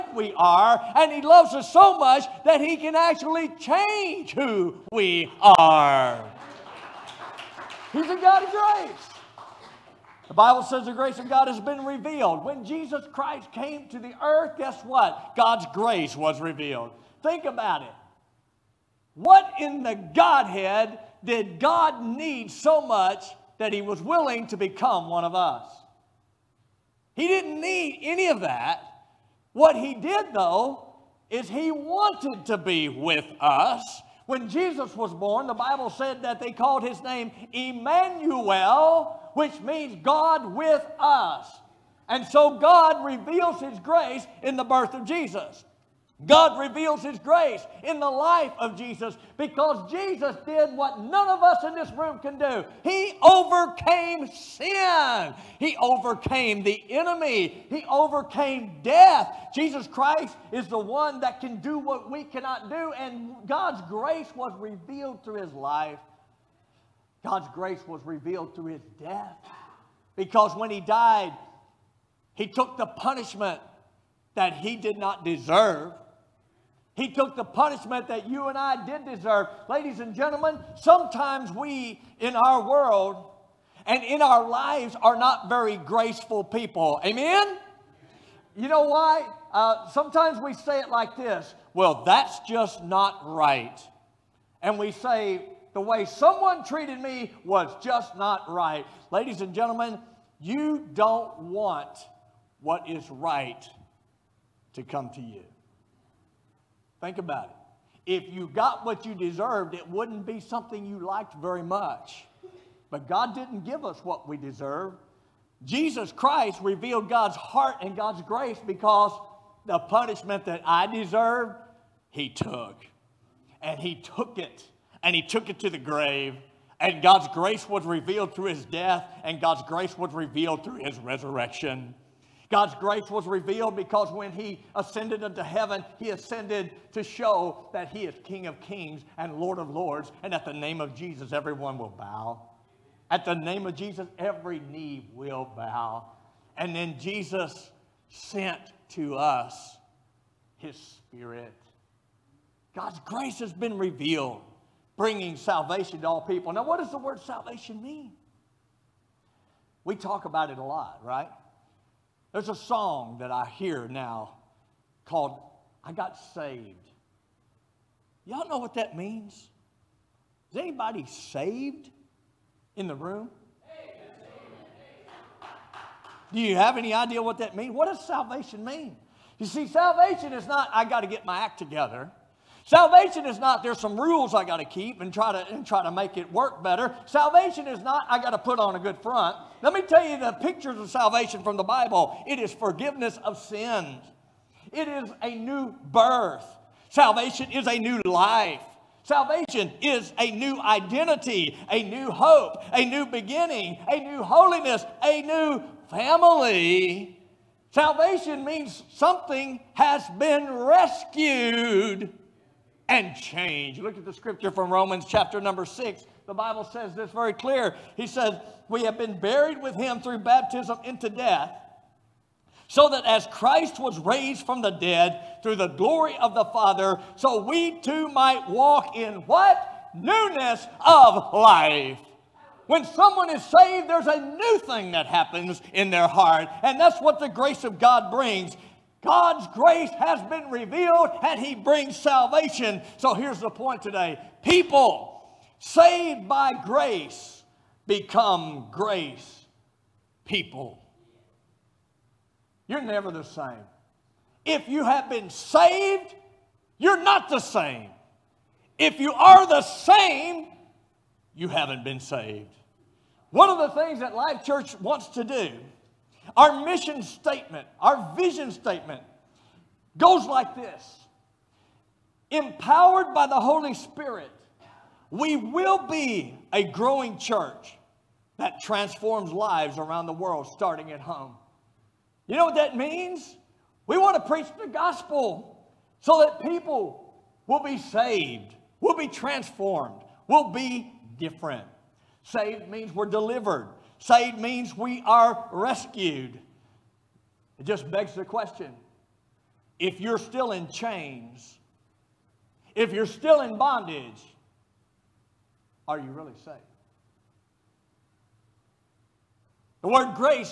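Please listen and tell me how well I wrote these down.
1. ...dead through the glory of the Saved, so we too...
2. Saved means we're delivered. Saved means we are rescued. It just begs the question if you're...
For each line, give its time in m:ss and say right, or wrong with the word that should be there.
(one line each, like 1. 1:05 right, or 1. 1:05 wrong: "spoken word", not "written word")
1. 3:44 wrong: "Father", not "Saved"
2. 4:52 right.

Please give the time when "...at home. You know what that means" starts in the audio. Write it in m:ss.
4:40.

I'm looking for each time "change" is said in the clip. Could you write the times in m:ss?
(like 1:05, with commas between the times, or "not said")
0:03, 3:33.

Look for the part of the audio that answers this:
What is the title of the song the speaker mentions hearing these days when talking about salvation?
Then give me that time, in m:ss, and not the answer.
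2:45.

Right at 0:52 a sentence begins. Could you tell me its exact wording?
He overcame sin, He overcame the enemy, He overcame death.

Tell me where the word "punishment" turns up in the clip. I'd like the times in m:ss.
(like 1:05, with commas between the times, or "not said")
1:12, 1:17, 1:59.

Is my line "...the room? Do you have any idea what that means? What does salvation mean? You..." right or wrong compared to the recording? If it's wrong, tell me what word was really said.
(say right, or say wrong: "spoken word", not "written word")
right.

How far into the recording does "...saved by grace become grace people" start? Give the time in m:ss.
4:05.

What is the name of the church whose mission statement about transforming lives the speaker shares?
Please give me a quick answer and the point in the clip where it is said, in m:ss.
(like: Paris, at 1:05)
Life Church, at 4:24.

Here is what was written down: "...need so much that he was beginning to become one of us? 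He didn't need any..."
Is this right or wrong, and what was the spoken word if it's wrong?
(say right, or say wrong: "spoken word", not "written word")
wrong: "willing", not "beginning".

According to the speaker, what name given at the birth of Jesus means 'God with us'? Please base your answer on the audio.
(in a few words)
Emmanuel.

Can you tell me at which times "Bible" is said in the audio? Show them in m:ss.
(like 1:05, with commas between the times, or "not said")
0:10, 0:35, 3:11, 3:36.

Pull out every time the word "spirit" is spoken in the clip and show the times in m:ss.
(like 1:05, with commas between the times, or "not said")
2:30, 4:33.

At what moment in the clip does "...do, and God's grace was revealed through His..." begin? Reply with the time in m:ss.
1:02.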